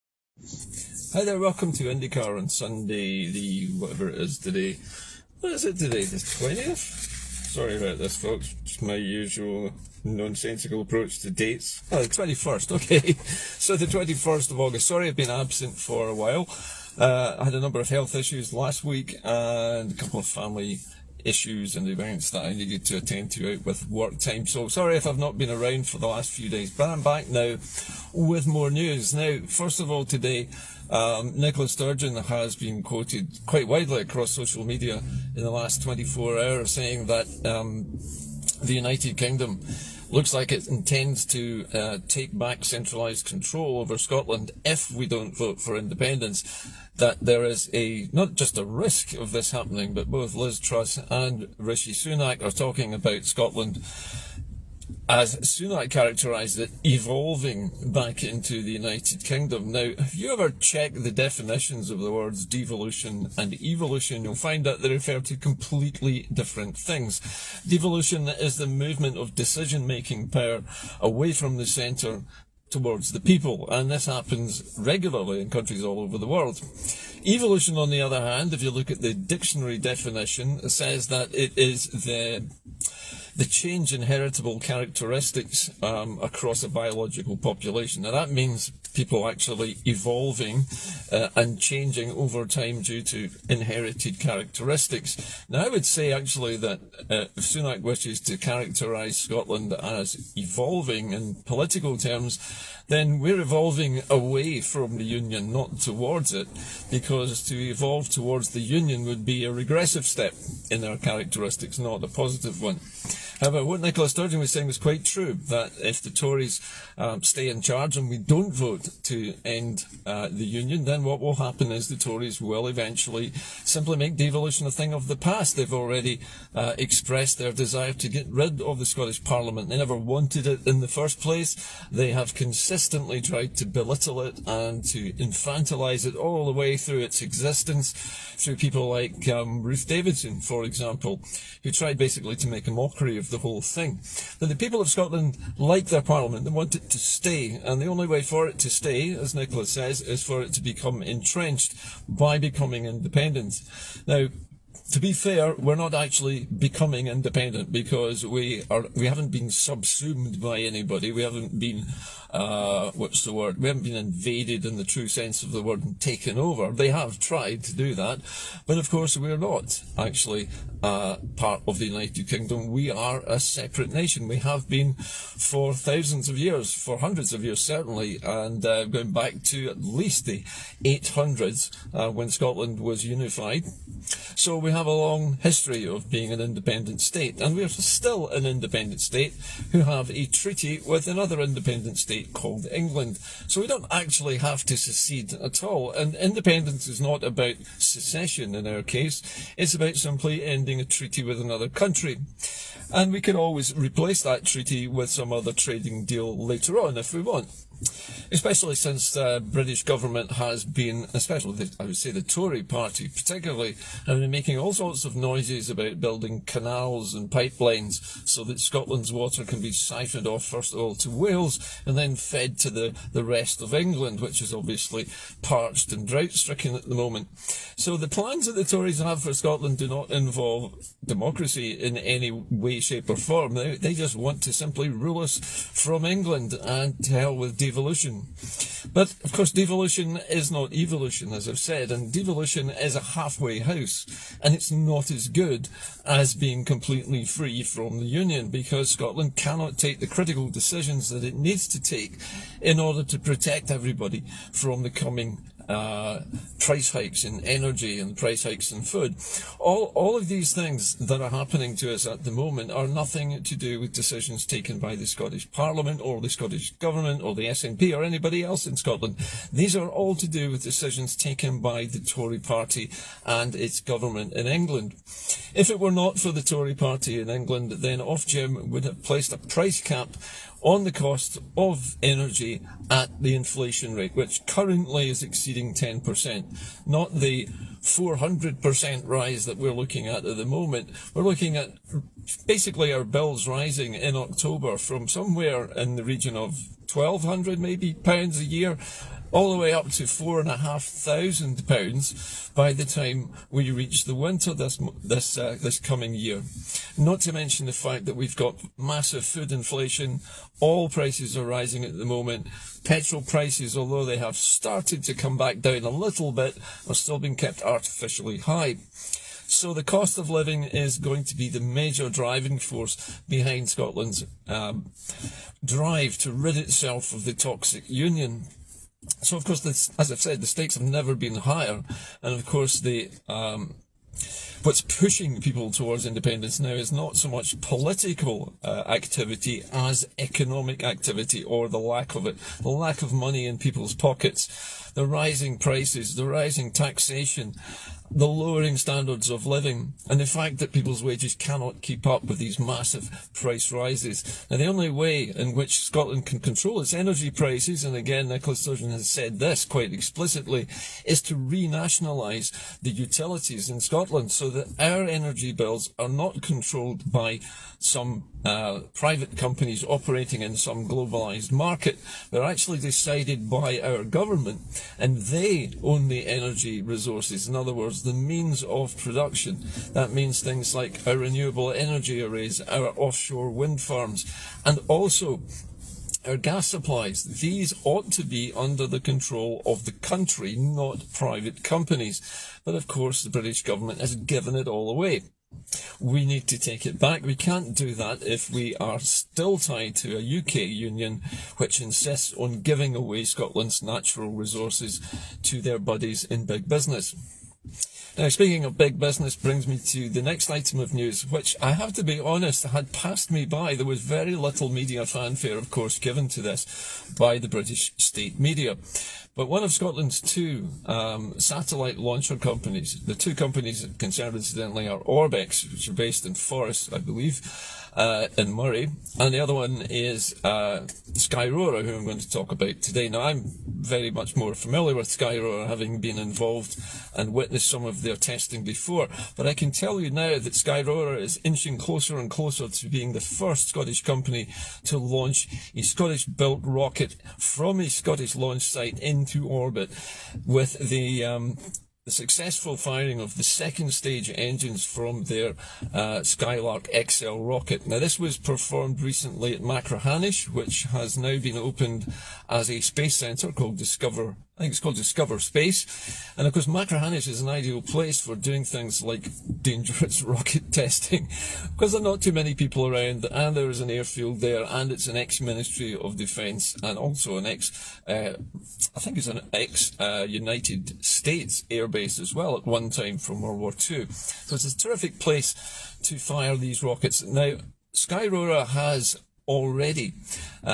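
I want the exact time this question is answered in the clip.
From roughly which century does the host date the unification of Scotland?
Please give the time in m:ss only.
3:00.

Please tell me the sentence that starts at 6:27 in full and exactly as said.
These ought to be under the control of the country, not private companies.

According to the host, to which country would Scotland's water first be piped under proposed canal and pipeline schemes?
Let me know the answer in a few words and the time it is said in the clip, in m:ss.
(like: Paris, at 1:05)
Wales, at 3:41.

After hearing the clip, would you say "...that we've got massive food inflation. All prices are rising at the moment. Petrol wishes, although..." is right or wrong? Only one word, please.
wrong.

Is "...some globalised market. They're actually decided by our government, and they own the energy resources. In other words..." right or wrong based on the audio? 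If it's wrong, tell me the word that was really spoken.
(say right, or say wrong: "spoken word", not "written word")
right.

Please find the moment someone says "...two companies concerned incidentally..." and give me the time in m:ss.
7:03.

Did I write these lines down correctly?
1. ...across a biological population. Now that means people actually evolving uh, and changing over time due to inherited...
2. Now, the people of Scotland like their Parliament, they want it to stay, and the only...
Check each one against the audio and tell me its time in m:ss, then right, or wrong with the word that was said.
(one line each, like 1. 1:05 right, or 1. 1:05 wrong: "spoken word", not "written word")
1. 1:26 right
2. 2:24 right.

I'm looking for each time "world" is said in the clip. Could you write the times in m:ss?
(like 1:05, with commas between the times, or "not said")
1:16, 8:03.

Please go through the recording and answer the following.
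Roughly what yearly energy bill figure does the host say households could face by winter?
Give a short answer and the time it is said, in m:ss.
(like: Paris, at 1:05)
£4,500, at 5:00.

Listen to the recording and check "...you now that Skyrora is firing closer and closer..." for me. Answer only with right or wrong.
wrong.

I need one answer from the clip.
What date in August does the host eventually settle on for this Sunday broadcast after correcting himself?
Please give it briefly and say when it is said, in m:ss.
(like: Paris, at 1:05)
21st, at 0:13.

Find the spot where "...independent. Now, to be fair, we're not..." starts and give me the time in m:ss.
2:32.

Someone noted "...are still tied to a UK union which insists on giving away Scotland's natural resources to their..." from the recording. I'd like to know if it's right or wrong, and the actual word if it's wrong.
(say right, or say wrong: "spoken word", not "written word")
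right.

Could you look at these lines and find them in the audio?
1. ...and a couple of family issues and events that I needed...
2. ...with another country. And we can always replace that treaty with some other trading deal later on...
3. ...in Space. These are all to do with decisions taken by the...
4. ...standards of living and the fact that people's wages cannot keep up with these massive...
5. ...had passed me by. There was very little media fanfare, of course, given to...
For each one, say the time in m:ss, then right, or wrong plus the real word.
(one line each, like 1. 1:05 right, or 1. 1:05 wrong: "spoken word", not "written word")
1. 0:19 right
2. 3:21 right
3. 4:28 wrong: "Scotland", not "Space"
4. 5:48 right
5. 6:52 right.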